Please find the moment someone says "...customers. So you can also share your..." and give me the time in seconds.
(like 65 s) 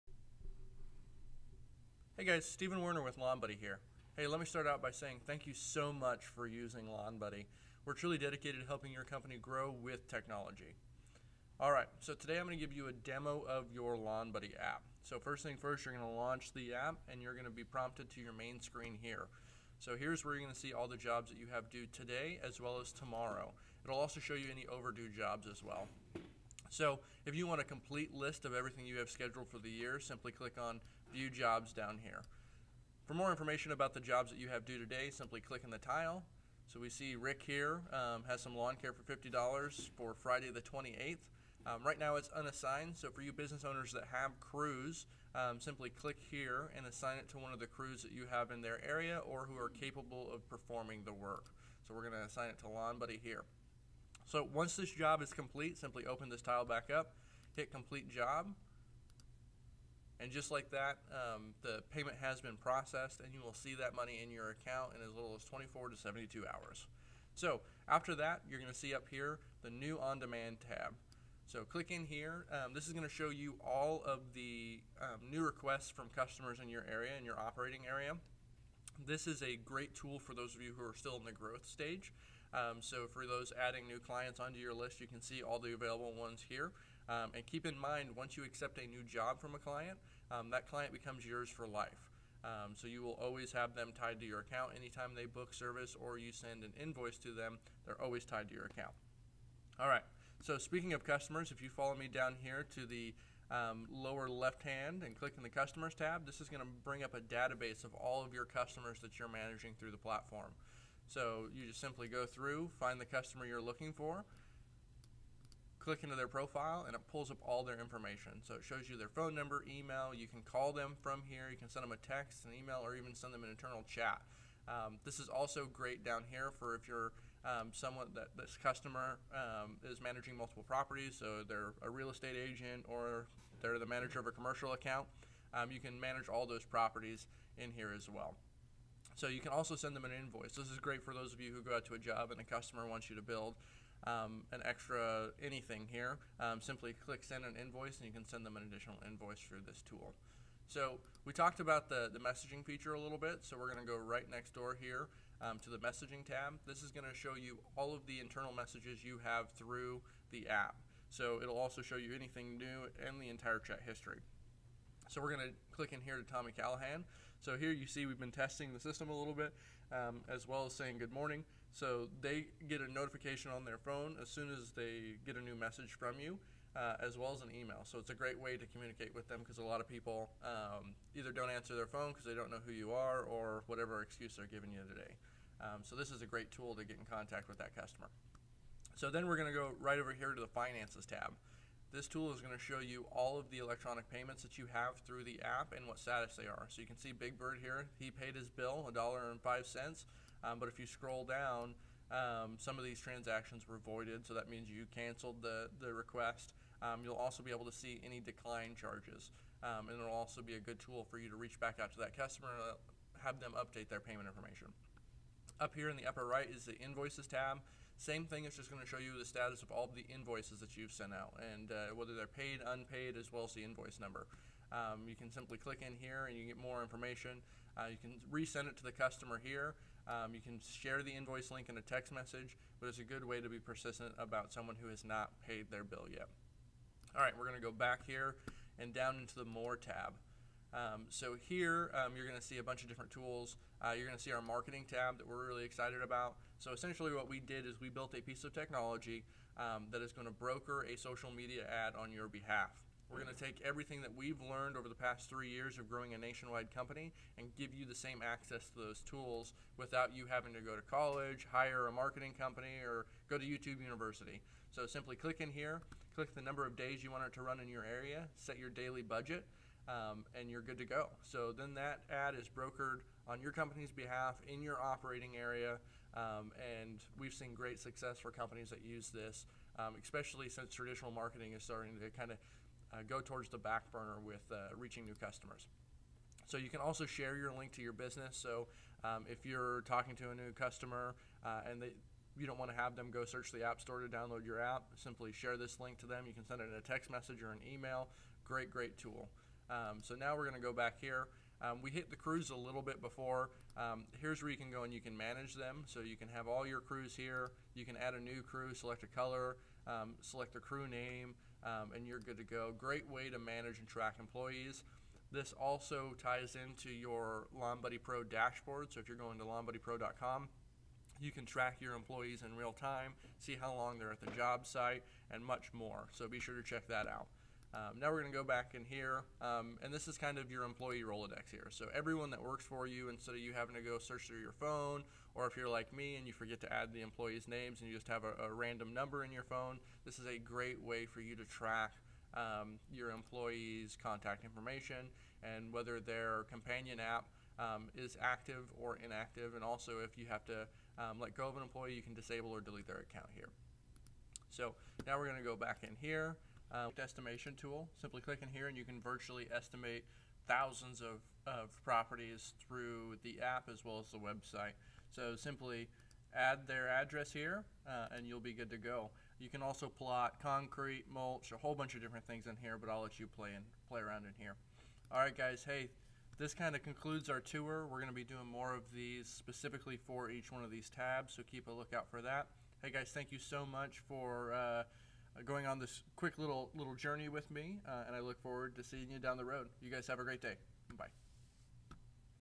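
285 s.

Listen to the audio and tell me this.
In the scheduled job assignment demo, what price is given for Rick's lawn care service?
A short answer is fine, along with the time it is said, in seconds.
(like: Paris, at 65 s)
$50, at 39 s.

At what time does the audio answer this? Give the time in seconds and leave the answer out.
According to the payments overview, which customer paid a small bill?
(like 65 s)
197 s.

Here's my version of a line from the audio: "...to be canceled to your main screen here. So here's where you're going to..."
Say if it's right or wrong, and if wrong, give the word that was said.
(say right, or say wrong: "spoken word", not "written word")
wrong: "prompted", not "canceled".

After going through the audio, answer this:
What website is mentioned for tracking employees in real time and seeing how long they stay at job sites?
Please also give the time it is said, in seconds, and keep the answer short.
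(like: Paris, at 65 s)
LawnBuddyPro.com, at 319 s.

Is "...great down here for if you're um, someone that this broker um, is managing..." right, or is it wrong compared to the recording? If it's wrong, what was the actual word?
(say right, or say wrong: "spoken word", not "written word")
wrong: "customer", not "broker".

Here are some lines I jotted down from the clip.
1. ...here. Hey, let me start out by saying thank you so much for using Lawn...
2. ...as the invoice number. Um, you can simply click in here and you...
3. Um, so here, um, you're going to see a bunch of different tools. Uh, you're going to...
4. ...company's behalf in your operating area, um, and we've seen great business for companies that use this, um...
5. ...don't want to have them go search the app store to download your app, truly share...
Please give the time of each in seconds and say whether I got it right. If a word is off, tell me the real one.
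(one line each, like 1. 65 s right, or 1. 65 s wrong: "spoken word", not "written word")
1. 3 s right
2. 223 s right
3. 240 s right
4. 273 s wrong: "success", not "business"
5. 292 s wrong: "simply", not "truly".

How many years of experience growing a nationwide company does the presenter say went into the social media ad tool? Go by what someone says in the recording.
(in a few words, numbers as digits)
3.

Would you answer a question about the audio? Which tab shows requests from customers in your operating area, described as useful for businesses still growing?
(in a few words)
on-demand tab.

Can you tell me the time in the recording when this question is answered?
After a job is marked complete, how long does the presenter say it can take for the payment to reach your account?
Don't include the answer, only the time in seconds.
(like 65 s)
65 s.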